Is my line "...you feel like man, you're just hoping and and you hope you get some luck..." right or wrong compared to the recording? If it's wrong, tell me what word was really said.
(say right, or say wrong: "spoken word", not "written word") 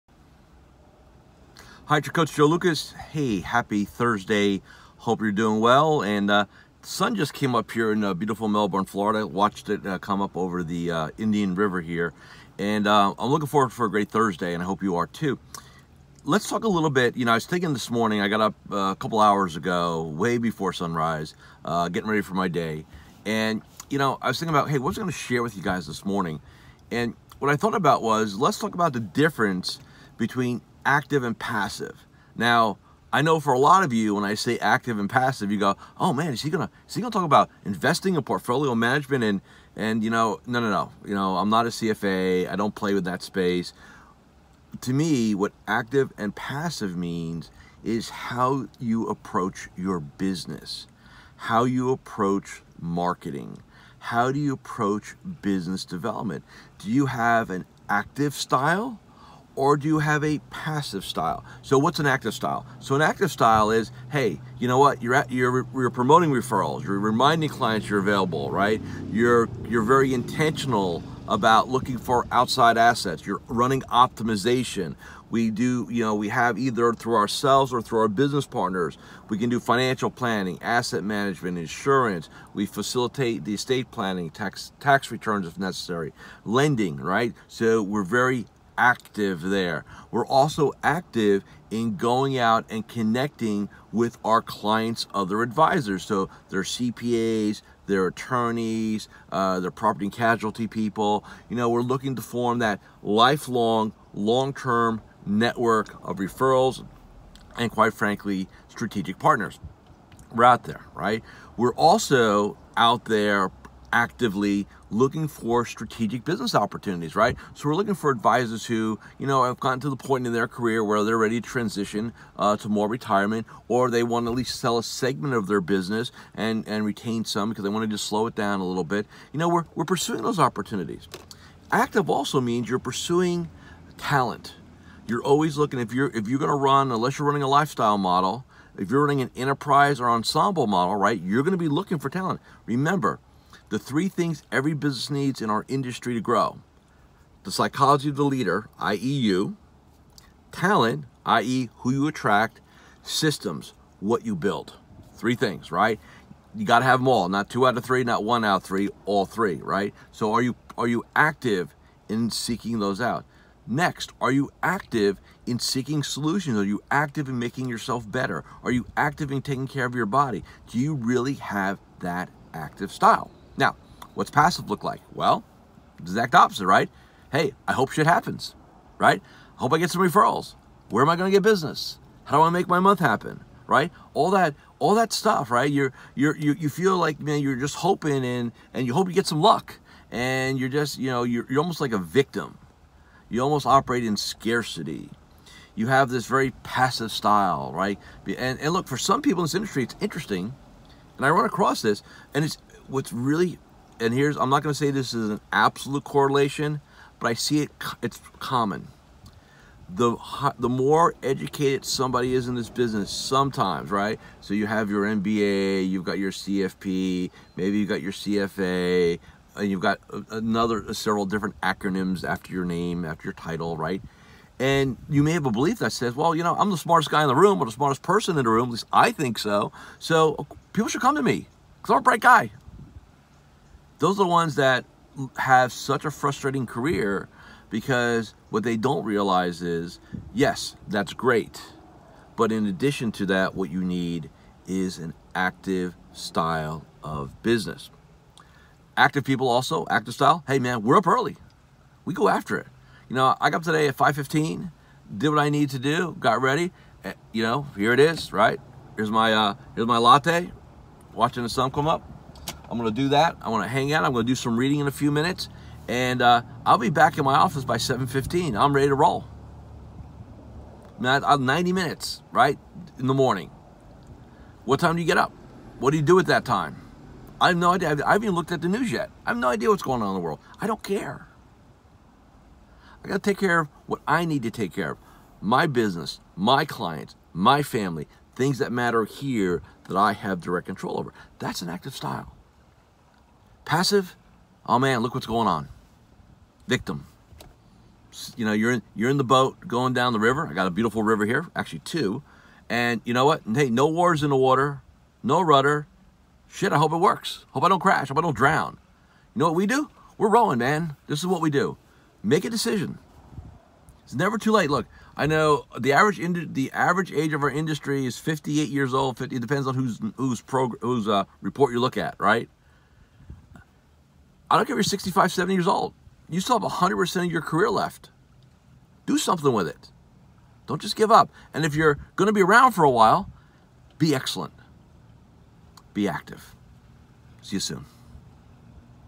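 right.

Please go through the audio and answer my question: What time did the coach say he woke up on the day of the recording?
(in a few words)
5:15.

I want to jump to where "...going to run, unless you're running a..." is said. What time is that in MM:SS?
02:16.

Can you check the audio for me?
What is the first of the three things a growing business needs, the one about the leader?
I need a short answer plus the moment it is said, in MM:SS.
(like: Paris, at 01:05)
psychology of the leader, at 02:27.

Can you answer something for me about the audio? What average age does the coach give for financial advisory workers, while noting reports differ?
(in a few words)
58 years old.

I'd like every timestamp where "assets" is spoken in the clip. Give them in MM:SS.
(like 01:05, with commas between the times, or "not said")
01:12, 01:20.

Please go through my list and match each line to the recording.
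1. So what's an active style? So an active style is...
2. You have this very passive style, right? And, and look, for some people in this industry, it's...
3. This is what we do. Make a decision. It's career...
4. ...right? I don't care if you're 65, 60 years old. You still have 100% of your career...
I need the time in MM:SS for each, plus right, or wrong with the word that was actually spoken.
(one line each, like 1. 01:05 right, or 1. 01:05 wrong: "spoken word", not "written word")
1. 01:01 right
2. 03:15 right
3. 05:11 wrong: "never", not "career"
4. 05:22 wrong: "70", not "60".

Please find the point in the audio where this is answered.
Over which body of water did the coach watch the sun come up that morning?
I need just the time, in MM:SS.
00:11.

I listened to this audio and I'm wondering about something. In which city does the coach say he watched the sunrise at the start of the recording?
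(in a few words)
Melbourne, Florida.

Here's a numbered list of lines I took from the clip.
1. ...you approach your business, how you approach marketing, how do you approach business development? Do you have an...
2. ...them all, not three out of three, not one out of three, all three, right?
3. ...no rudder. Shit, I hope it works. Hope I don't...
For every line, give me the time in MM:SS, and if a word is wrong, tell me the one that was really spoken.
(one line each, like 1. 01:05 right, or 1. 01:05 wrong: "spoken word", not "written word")
1. 00:48 right
2. 02:36 wrong: "two", not "three"
3. 05:05 right.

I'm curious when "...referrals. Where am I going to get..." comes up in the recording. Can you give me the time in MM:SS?
03:00.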